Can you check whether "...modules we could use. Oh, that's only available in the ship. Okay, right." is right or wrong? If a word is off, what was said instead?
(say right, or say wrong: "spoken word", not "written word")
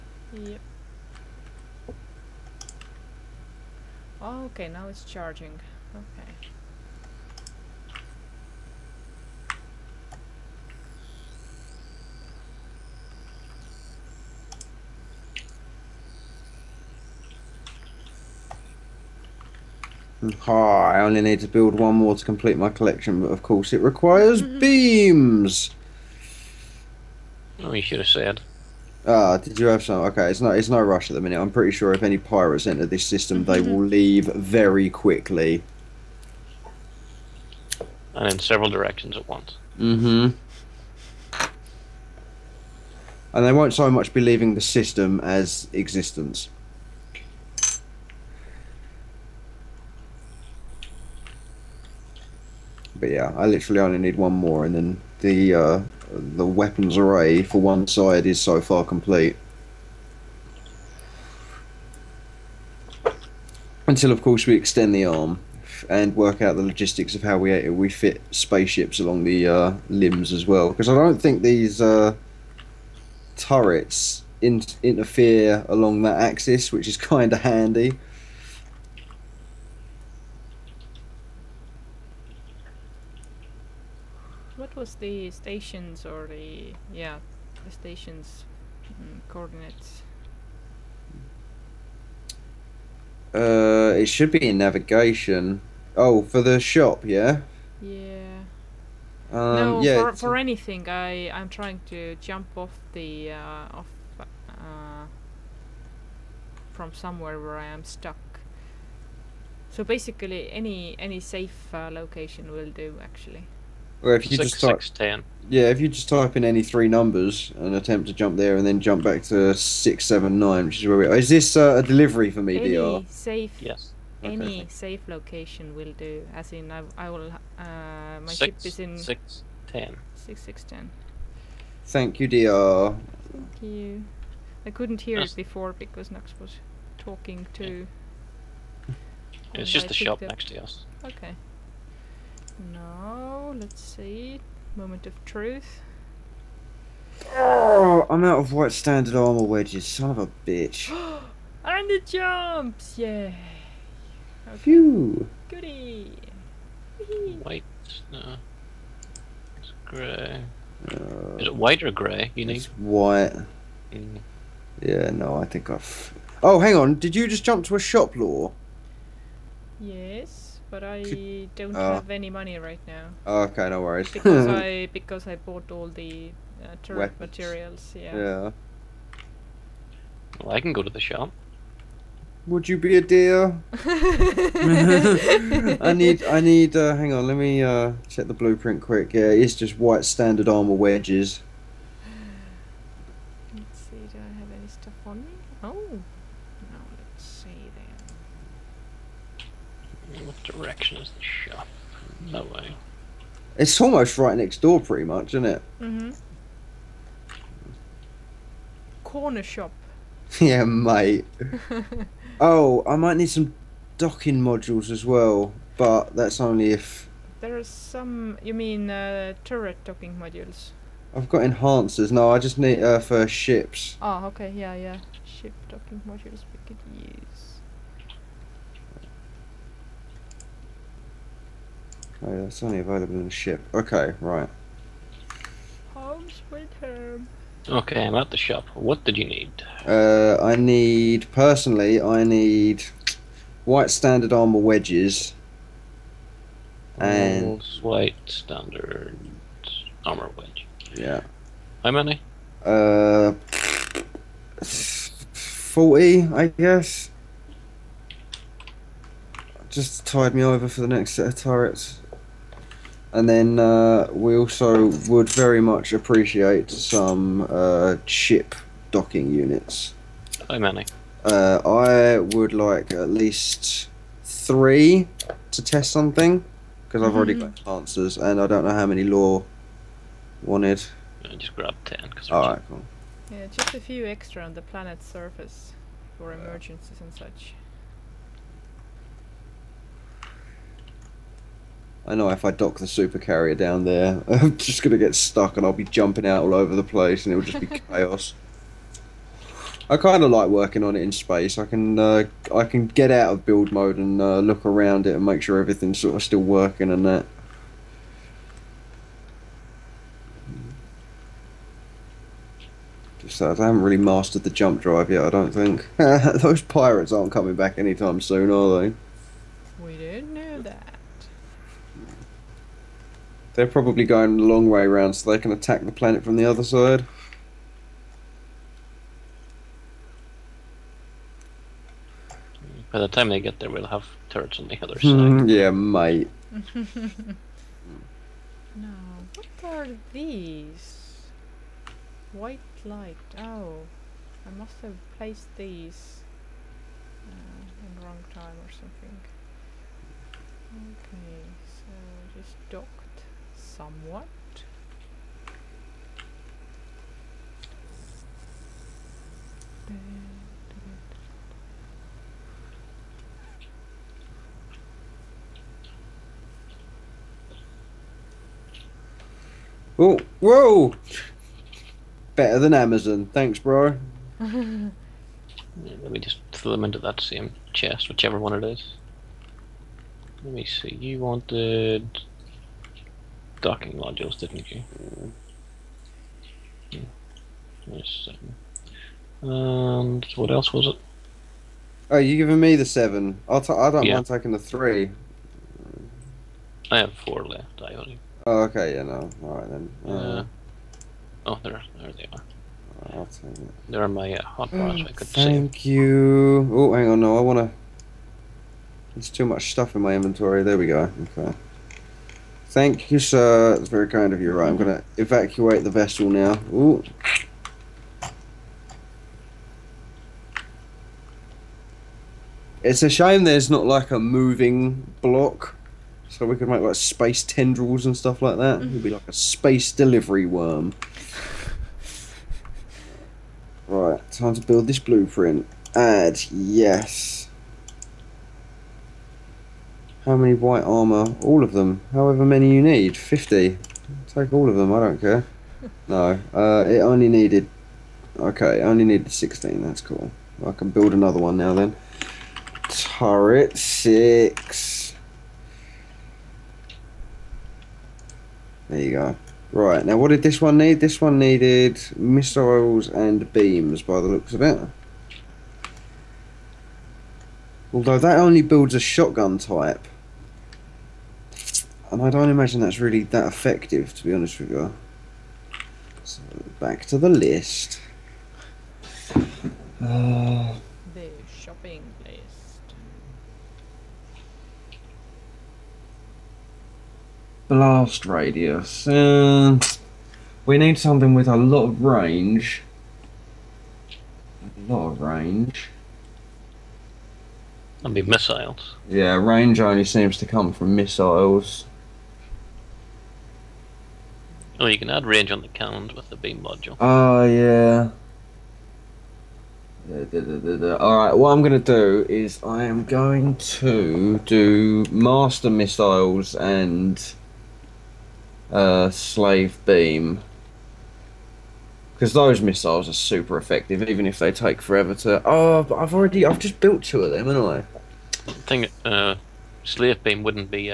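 right.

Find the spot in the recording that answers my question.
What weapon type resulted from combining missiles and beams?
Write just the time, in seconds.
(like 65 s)
468 s.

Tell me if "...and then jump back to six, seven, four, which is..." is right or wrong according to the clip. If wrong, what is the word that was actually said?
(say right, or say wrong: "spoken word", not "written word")
wrong: "nine", not "four".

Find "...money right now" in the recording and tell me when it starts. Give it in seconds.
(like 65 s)
172 s.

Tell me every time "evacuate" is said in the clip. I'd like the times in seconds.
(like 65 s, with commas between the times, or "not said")
415 s.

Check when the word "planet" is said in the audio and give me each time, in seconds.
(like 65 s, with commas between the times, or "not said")
284 s, 325 s.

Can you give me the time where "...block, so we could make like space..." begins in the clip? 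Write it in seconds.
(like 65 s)
425 s.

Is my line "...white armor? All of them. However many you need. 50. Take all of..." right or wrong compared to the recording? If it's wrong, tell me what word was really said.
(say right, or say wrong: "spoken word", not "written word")
right.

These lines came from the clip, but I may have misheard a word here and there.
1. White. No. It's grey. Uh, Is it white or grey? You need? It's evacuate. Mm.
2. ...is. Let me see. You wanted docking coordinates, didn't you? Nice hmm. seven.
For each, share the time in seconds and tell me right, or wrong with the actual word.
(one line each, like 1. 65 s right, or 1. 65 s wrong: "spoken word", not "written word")
1. 157 s wrong: "white", not "evacuate"
2. 378 s wrong: "modules", not "coordinates".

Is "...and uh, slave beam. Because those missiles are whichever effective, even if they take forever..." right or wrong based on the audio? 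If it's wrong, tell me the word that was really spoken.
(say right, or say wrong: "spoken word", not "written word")
wrong: "super", not "whichever".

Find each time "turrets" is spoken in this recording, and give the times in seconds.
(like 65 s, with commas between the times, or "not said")
73 s, 176 s, 219 s, 261 s, 334 s, 452 s.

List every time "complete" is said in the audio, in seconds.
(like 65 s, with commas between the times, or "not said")
22 s, 58 s.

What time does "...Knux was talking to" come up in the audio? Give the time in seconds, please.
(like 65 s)
136 s.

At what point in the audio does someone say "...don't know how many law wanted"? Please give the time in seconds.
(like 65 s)
278 s.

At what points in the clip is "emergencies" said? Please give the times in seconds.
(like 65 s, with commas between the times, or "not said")
286 s.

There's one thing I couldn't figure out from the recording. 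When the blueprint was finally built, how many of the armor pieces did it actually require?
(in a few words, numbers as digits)
16.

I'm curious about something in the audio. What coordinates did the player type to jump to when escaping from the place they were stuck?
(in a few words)
6, 10.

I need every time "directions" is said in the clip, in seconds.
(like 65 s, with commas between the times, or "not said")
38 s, 200 s.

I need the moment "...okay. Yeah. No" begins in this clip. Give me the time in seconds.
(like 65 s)
398 s.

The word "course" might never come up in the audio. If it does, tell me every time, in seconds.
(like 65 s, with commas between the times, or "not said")
23 s, 64 s.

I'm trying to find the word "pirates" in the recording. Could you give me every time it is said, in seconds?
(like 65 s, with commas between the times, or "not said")
32 s, 316 s.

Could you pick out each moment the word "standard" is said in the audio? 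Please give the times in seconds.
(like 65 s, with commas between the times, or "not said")
148 s, 190 s, 243 s, 248 s.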